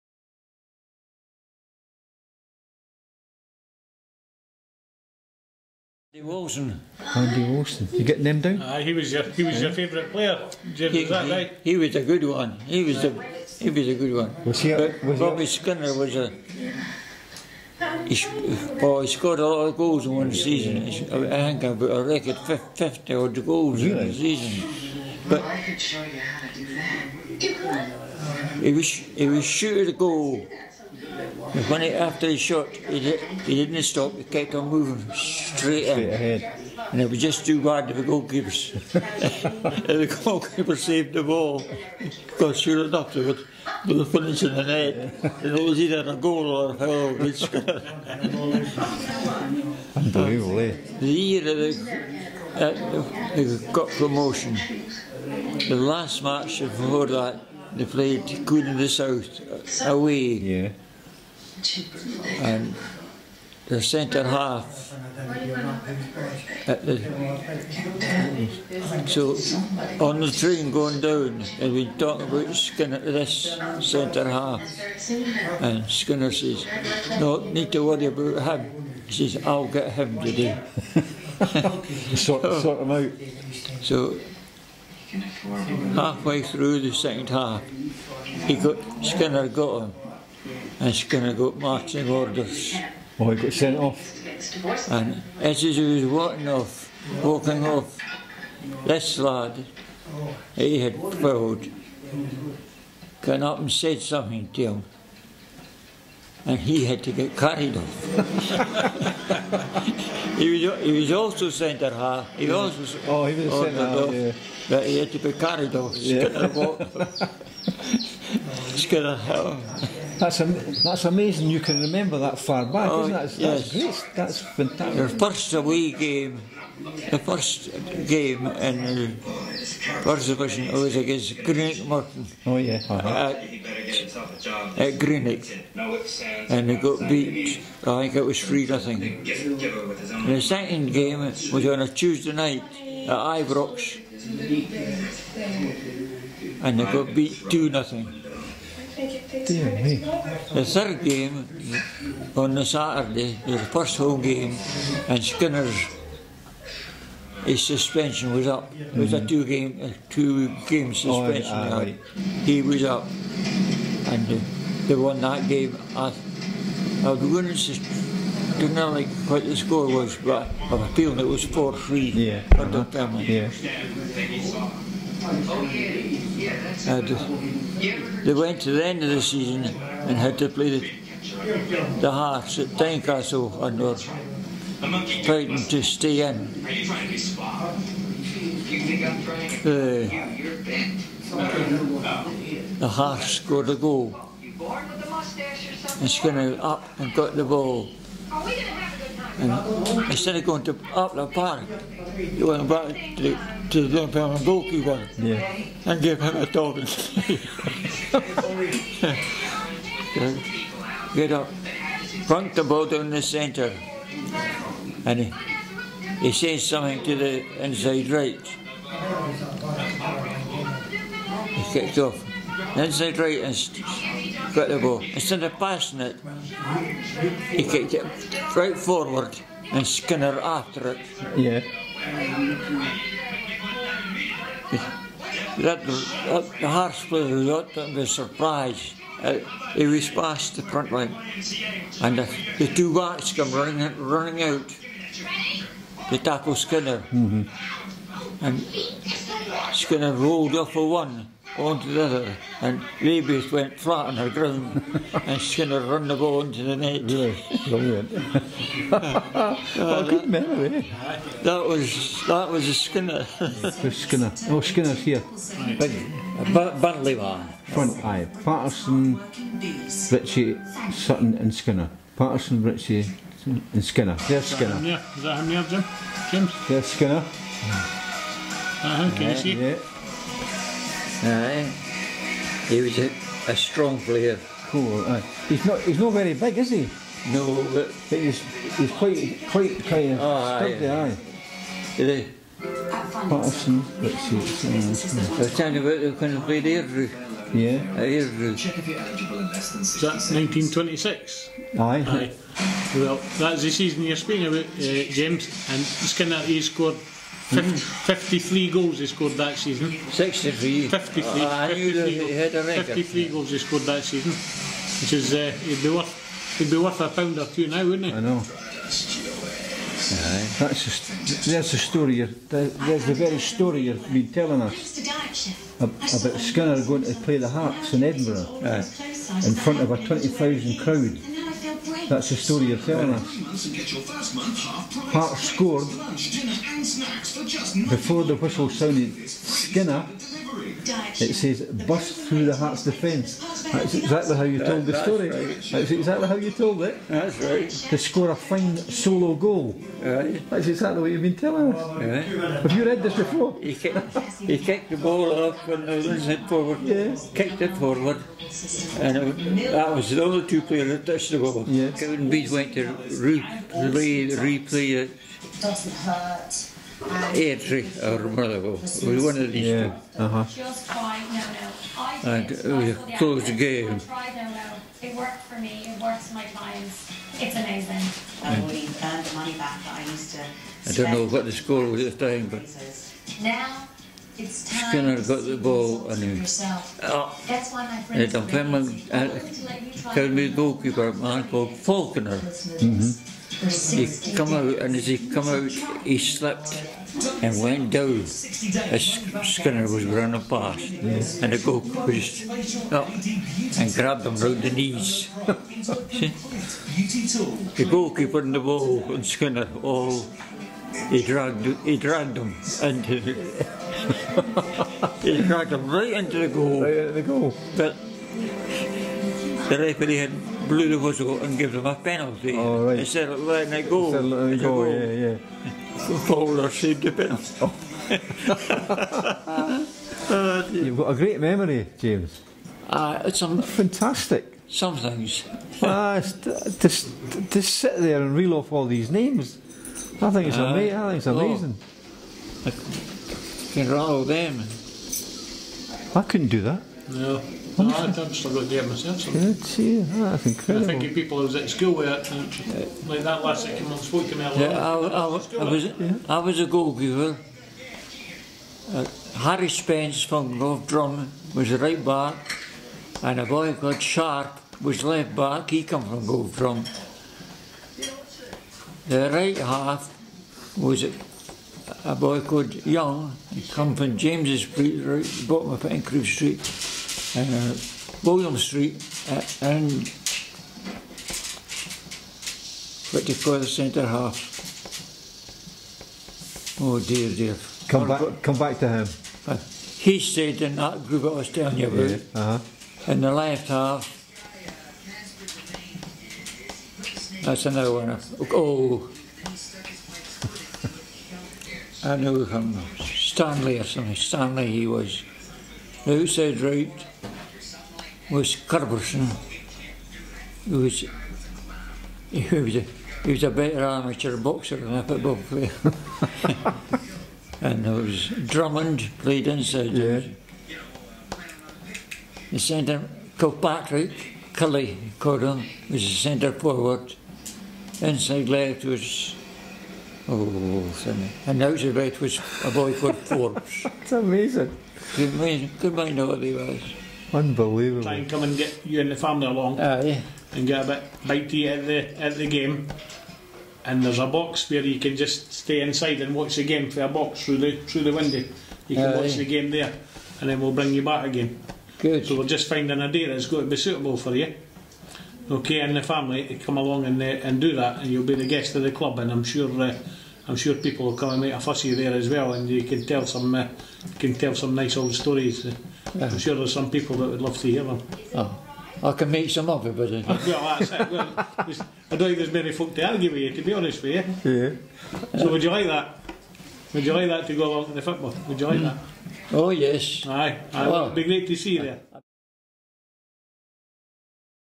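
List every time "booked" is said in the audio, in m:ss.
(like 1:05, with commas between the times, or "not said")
not said.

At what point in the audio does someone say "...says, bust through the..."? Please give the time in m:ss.
5:41.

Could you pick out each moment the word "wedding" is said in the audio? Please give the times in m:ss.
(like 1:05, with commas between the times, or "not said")
not said.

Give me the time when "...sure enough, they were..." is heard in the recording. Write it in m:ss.
0:42.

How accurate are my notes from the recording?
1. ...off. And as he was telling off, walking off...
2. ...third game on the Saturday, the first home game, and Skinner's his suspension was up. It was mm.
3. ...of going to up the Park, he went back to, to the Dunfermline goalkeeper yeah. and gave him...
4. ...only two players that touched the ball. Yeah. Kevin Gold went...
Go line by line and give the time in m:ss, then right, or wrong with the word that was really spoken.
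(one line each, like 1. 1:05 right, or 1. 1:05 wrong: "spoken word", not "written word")
1. 1:33 wrong: "walking", not "telling"
2. 2:30 right
3. 3:20 right
4. 6:00 wrong: "Beach", not "Gold".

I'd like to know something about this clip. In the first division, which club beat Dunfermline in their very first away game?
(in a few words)
Greenock Morton.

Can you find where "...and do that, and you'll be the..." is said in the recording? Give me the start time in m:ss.
9:17.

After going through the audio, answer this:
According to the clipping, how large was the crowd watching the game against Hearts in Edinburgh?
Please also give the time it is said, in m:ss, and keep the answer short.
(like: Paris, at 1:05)
20,000, at 5:30.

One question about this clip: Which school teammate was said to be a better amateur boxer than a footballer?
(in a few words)
Curbison.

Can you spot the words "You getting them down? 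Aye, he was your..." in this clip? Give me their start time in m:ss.
0:07.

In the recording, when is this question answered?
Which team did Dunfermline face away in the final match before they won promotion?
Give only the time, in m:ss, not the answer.
0:58.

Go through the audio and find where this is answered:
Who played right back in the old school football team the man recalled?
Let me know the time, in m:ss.
7:39.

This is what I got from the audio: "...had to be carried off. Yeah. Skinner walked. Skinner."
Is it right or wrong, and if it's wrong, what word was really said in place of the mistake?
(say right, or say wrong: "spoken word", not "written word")
right.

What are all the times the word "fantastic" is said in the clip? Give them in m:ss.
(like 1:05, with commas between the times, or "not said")
2:04, 7:13.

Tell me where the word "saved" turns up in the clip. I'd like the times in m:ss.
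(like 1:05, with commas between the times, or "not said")
0:40, 7:06.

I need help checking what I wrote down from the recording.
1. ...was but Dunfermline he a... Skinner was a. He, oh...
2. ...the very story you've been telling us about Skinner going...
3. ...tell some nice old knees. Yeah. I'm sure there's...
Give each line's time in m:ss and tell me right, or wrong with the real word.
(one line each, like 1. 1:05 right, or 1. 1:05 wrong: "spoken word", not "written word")
1. 0:14 wrong: "Bobby", not "Dunfermline"
2. 5:23 right
3. 9:24 wrong: "stories", not "knees".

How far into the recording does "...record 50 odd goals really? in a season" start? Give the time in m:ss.
0:22.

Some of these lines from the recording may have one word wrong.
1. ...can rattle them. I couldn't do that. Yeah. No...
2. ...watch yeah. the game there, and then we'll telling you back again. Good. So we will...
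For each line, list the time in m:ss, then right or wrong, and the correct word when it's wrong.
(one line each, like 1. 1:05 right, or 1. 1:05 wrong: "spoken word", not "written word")
1. 7:23 right
2. 9:09 wrong: "bring", not "telling".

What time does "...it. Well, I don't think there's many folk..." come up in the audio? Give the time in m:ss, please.
9:30.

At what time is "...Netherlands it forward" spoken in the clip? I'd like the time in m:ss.
5:55.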